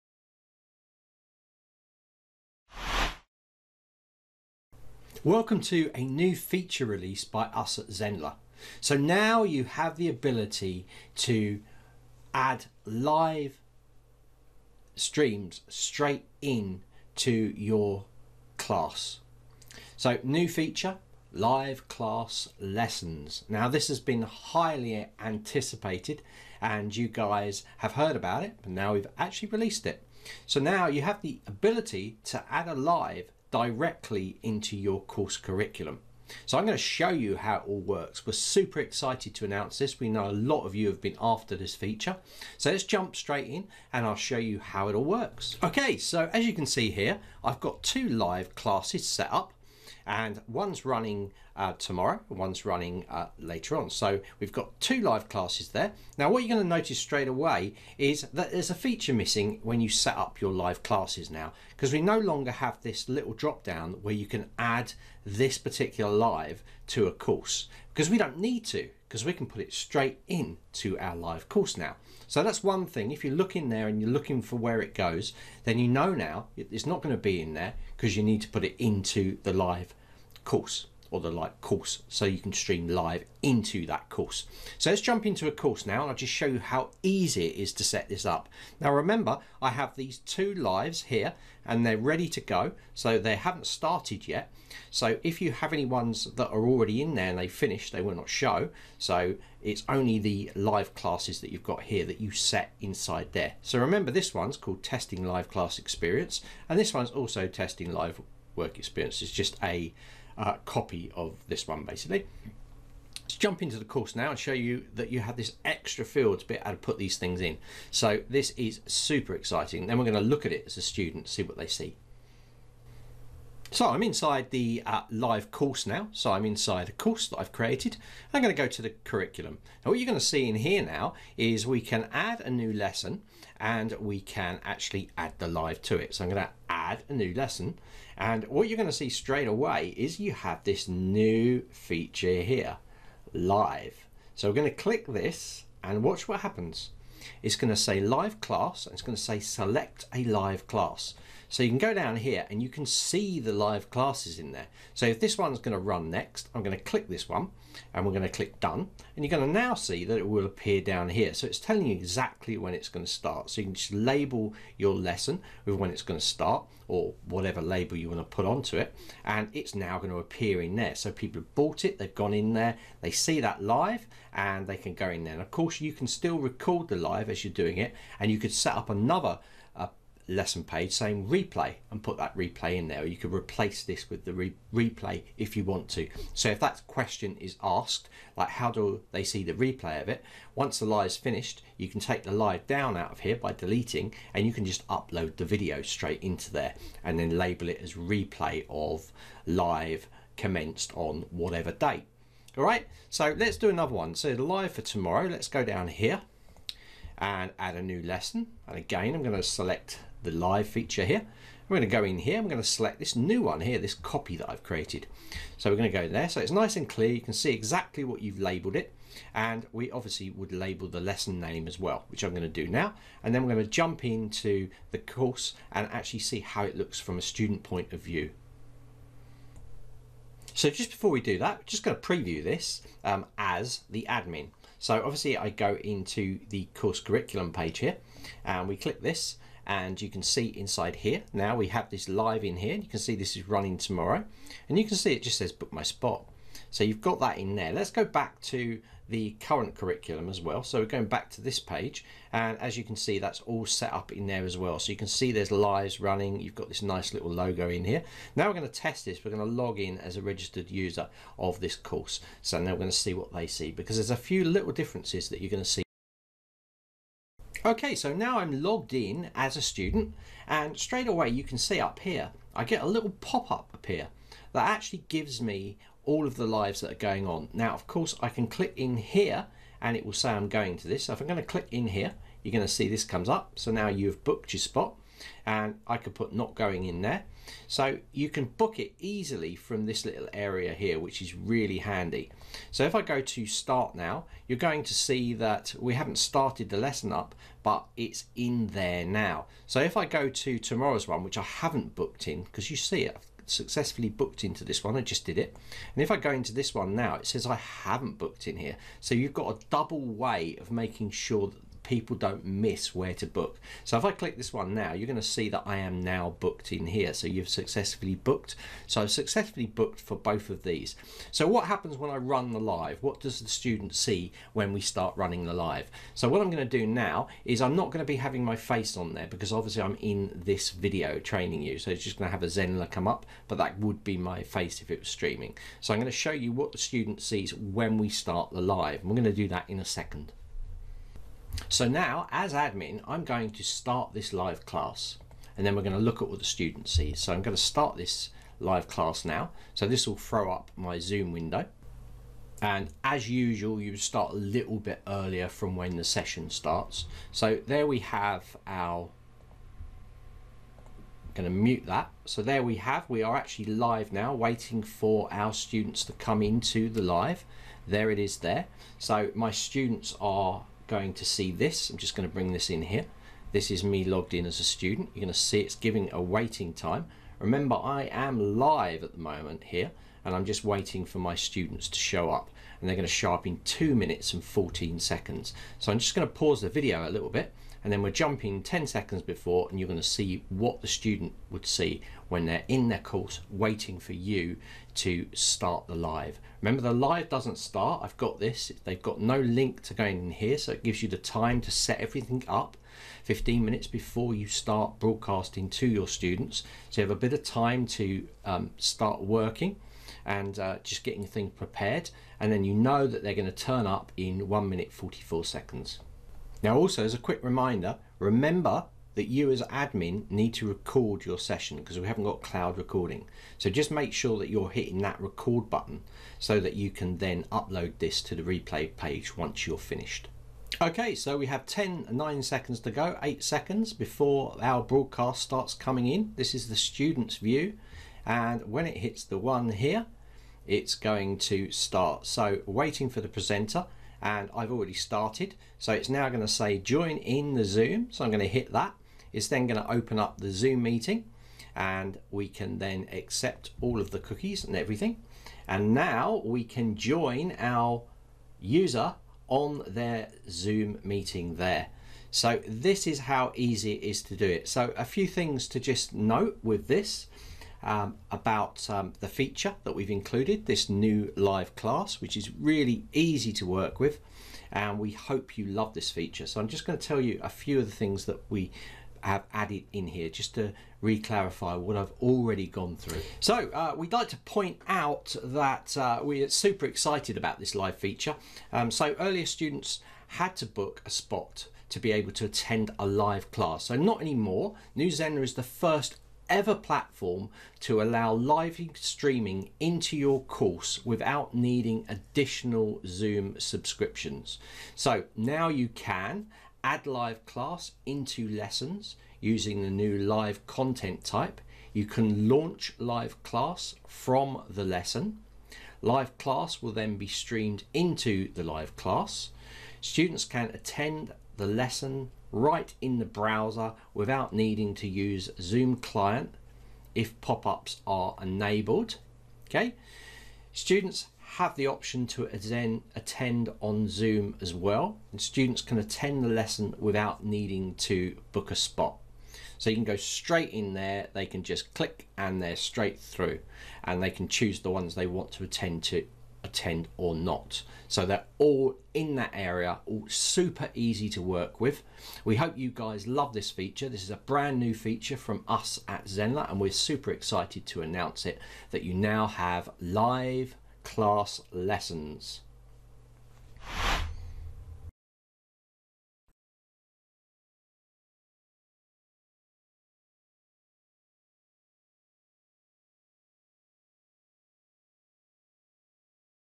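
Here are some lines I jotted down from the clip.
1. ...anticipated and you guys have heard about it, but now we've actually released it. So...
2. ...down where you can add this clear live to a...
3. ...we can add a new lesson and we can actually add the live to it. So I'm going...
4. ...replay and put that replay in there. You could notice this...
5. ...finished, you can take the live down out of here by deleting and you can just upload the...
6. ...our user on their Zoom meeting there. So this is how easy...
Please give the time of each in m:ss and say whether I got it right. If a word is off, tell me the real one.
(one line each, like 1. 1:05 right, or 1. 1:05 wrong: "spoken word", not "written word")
1. 0:25 right
2. 1:03 wrong: "particular", not "clear"
3. 2:11 right
4. 3:01 wrong: "replace", not "notice"
5. 3:11 right
6. 7:37 right.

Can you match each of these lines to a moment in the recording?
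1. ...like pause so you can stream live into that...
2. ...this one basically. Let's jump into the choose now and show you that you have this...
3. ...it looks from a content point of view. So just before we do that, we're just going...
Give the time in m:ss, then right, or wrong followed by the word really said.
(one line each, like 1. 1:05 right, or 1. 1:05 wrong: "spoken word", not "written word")
1. 1:21 wrong: "course", not "pause"
2. 1:51 wrong: "course", not "choose"
3. 3:46 wrong: "student", not "content".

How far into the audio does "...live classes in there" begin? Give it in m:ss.
2:33.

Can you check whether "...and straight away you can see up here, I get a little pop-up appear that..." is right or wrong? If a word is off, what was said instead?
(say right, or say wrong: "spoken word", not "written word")
right.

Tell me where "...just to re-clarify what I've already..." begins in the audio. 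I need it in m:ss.
8:00.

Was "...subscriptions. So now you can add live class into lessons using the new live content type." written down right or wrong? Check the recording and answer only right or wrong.
right.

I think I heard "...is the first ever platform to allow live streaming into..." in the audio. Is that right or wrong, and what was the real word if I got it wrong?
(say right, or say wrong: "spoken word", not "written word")
right.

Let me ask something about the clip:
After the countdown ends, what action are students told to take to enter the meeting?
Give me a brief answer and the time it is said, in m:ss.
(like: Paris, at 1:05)
join in the Zoom, at 7:26.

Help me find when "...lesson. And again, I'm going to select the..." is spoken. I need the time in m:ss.
3:28.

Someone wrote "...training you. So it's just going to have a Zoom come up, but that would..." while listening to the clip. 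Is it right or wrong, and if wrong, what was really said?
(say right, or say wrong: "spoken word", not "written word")
wrong: "Zenler", not "Zoom".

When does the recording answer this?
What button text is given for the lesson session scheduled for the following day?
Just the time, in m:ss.
4:05.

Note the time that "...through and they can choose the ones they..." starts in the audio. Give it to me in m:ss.
9:03.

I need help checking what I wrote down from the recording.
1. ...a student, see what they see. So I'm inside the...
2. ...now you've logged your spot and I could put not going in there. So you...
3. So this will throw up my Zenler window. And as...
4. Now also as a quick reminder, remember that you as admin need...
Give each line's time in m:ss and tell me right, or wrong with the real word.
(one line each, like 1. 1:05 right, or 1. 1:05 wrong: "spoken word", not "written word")
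1. 2:00 right
2. 4:43 wrong: "booked", not "logged"
3. 5:49 wrong: "Zoom", not "Zenler"
4. 6:56 right.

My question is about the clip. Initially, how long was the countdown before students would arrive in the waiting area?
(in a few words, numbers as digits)
2 minutes 14 seconds.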